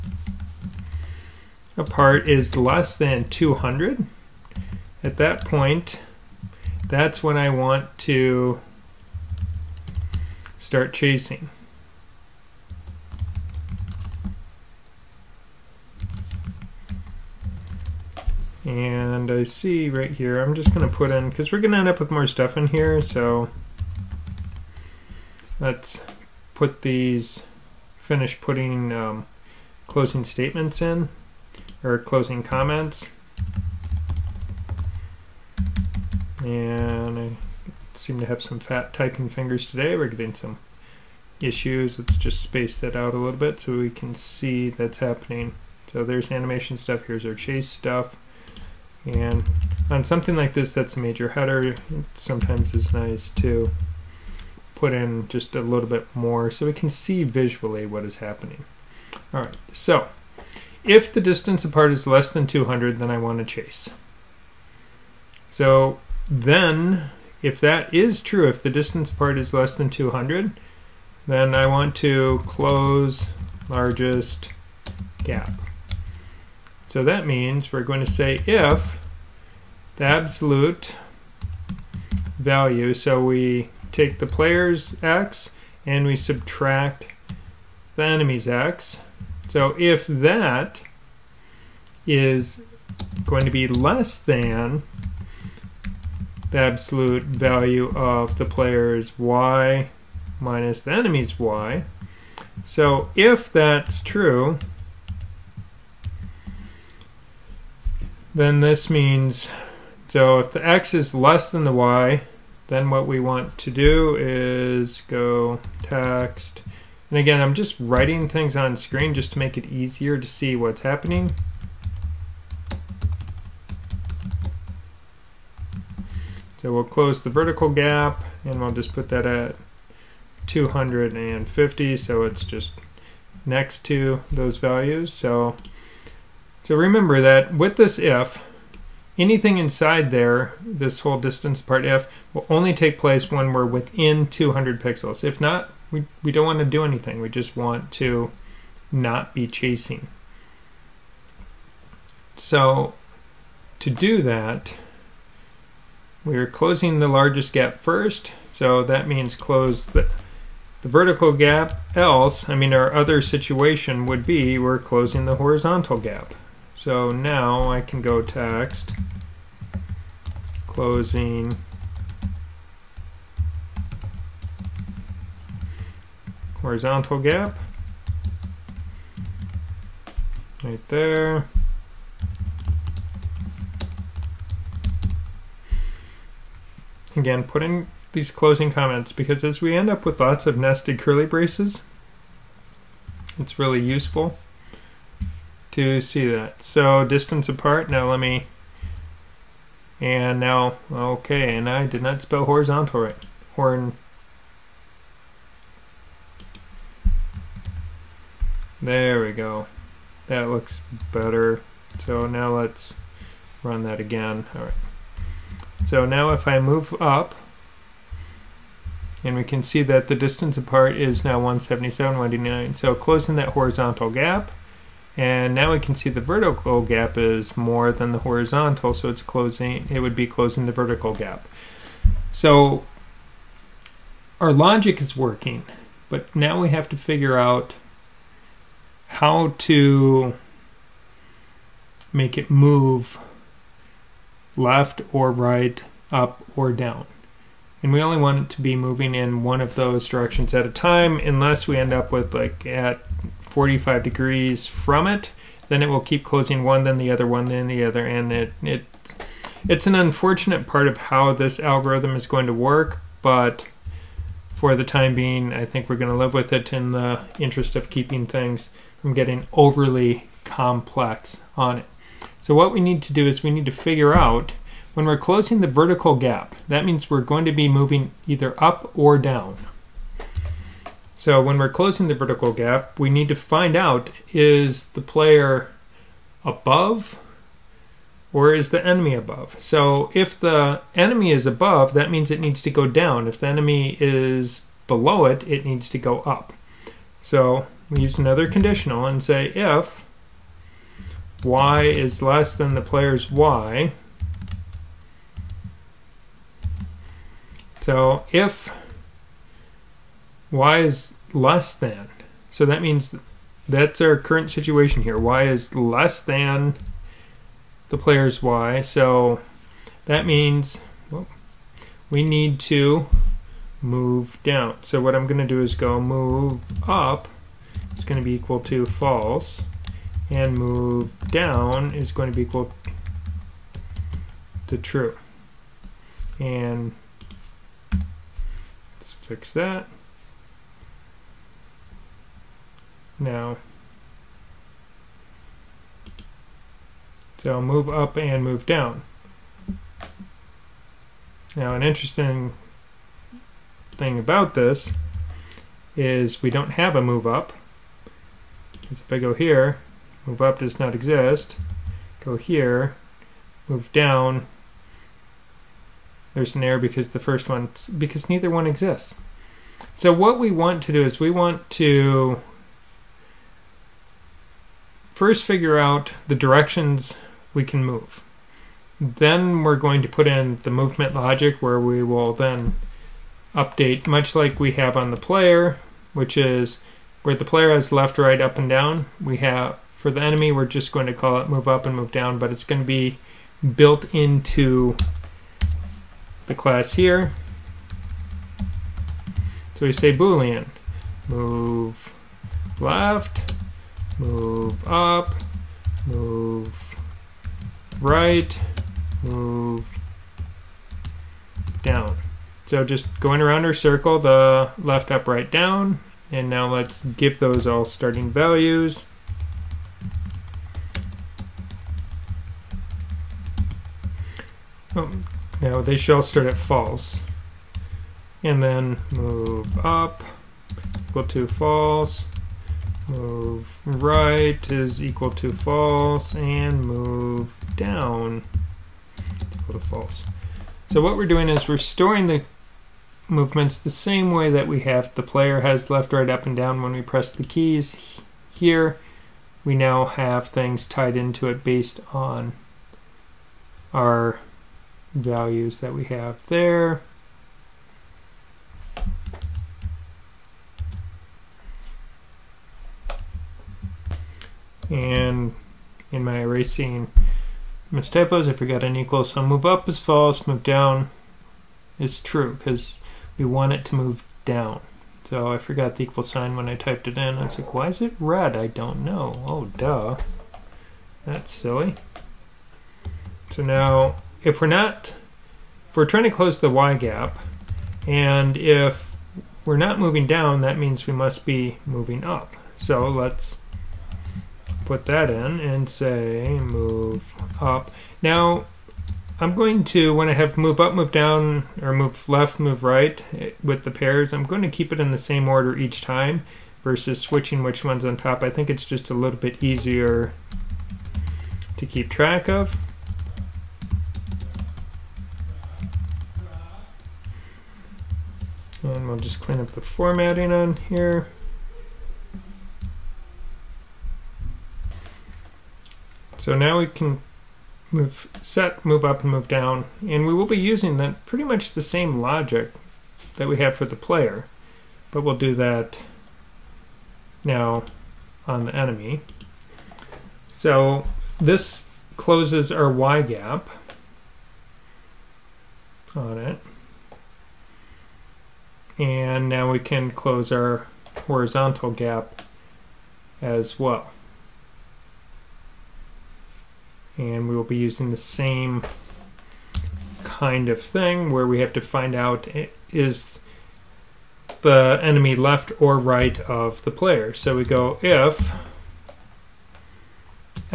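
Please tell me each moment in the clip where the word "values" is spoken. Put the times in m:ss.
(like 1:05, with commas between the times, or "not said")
1:22, 1:37, 2:14, 6:58, 7:35.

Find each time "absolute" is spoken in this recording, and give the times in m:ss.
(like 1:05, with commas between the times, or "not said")
1:20, 1:36.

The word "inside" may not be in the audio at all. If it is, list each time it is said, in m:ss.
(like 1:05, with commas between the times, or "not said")
2:19.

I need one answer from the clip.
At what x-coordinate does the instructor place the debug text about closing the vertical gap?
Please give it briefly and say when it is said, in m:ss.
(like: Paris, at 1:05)
250, at 2:10.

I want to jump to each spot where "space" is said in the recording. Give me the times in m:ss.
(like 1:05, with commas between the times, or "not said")
0:42.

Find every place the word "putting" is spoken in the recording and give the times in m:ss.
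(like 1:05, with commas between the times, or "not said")
0:28.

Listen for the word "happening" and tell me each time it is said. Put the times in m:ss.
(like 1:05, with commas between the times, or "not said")
0:44, 0:58, 2:00.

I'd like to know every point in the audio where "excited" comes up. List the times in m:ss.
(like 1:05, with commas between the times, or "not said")
not said.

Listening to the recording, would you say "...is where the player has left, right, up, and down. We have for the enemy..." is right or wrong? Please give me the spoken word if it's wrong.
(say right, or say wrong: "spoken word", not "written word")
right.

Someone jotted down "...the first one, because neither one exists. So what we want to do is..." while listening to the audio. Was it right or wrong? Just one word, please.
right.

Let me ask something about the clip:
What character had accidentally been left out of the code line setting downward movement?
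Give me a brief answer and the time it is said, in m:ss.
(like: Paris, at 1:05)
equal sign, at 7:56.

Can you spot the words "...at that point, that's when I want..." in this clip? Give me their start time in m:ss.
0:05.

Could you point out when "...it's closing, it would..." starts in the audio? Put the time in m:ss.
3:49.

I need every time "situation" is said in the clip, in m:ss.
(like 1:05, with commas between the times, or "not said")
2:43, 5:14.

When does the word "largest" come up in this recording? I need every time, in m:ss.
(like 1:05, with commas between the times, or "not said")
1:13, 2:37.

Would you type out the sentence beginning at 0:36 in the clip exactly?
And I seem to have some fat typing fingers today.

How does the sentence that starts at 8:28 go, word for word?
I think it's just a little bit easier to keep track of.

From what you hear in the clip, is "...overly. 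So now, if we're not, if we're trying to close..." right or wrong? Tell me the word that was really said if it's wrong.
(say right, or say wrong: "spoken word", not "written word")
wrong: "silly", not "overly".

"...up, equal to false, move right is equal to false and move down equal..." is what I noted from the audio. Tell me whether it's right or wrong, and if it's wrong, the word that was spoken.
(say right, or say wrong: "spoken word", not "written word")
right.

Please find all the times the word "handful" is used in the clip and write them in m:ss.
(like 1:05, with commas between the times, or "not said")
not said.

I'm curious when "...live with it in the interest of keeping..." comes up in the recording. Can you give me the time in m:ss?
4:26.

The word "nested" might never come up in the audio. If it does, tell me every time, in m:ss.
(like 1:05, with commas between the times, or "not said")
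3:10.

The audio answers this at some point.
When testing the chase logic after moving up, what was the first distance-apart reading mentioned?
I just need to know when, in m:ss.
3:41.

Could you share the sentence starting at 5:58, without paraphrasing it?
Because if I go here, move up does not exist.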